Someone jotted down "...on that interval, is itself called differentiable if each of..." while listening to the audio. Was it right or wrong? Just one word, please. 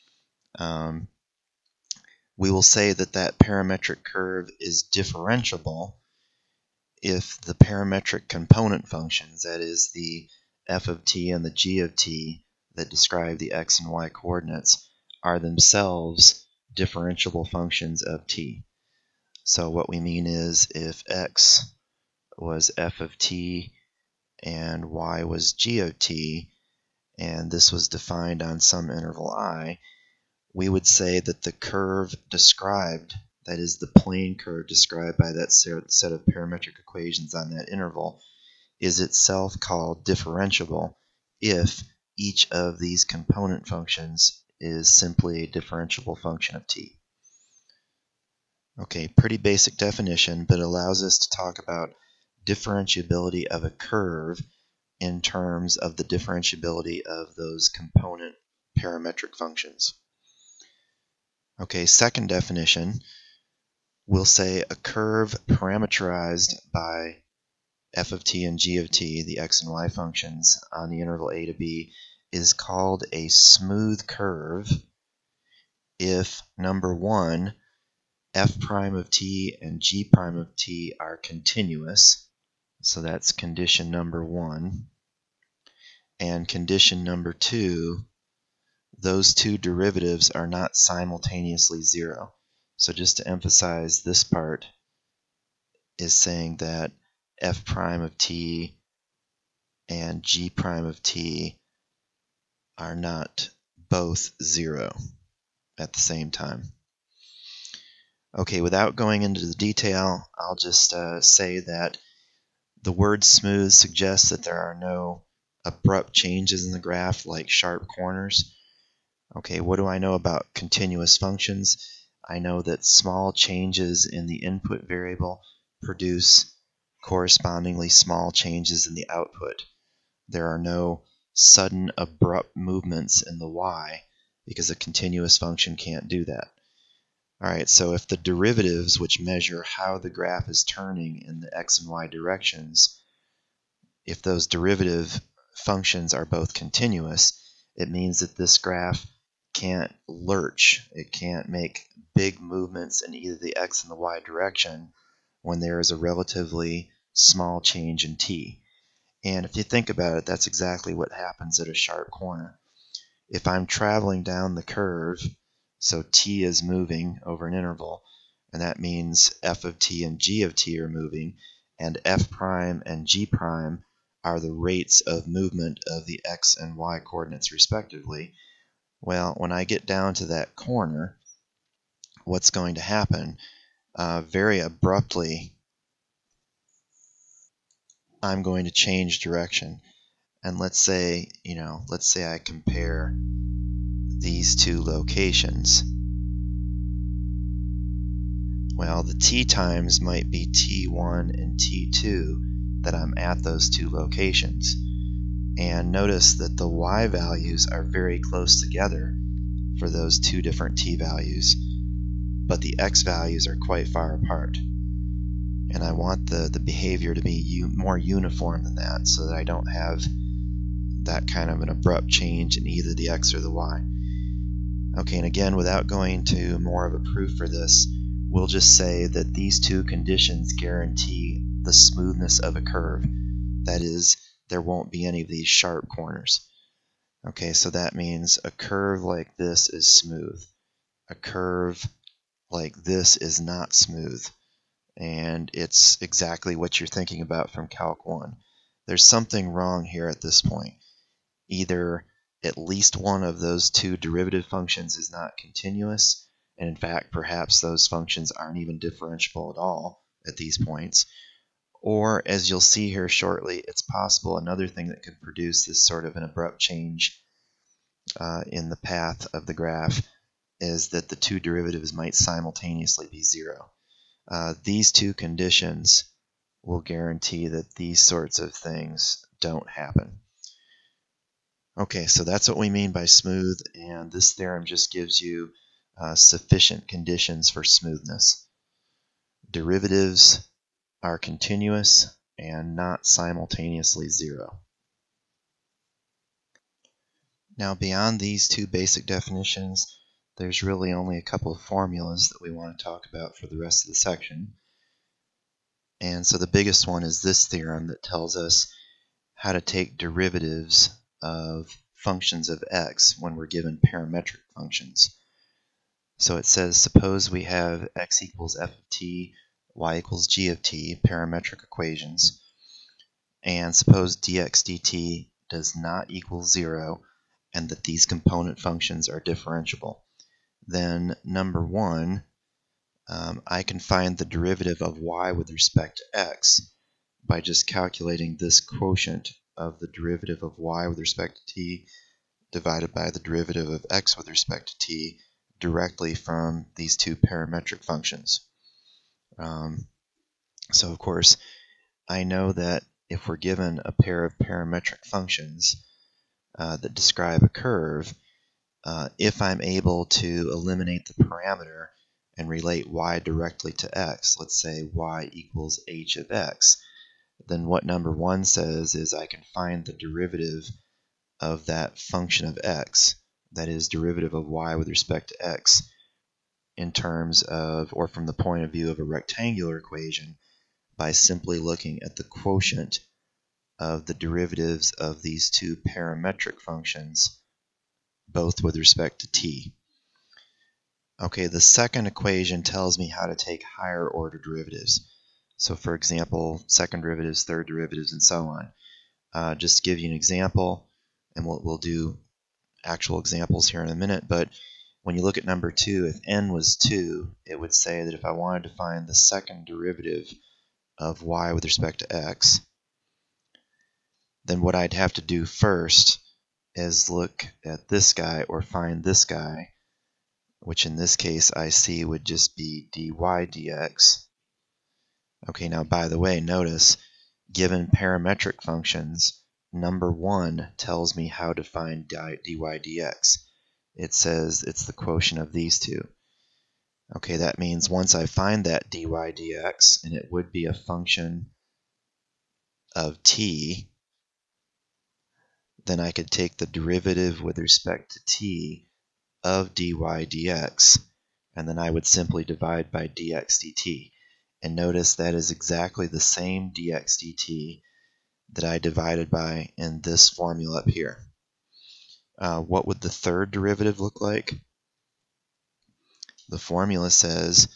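right.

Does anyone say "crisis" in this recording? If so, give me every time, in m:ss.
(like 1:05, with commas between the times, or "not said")
not said.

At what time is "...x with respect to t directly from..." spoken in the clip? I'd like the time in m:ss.
5:43.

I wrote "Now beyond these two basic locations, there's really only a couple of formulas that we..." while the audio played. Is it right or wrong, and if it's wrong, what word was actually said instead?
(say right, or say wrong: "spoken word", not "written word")
wrong: "definitions", not "locations".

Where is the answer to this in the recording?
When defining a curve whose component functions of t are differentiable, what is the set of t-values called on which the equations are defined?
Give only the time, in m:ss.
0:28.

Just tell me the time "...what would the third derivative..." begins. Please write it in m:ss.
7:42.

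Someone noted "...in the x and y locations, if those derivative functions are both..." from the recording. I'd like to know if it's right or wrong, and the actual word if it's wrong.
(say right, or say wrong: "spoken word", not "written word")
wrong: "directions", not "locations".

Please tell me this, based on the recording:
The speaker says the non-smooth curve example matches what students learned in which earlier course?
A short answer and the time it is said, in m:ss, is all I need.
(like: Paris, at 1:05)
Calc 1, at 4:07.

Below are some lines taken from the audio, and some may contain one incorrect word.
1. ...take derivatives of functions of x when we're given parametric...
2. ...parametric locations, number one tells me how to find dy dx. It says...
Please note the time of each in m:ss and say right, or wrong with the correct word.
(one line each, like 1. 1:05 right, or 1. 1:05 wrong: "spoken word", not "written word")
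1. 5:09 right
2. 7:07 wrong: "functions", not "locations".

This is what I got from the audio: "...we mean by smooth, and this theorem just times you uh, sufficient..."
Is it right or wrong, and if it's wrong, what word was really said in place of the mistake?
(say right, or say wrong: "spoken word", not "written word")
wrong: "gives", not "times".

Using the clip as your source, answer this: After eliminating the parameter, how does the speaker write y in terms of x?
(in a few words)
h of x.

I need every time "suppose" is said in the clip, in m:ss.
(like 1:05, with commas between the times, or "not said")
5:16, 5:23.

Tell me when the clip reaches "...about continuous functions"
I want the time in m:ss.
2:00.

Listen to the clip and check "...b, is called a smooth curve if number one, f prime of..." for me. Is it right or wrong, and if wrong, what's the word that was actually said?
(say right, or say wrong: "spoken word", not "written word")
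right.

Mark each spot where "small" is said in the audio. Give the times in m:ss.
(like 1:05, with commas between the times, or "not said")
2:02, 2:07, 2:37.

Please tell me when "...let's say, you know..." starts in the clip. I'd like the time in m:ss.
3:10.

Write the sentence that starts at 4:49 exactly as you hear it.
Derivatives are continuous and not simultaneously zero.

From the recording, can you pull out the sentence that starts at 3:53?
That is, there won't be any of these sharp corners.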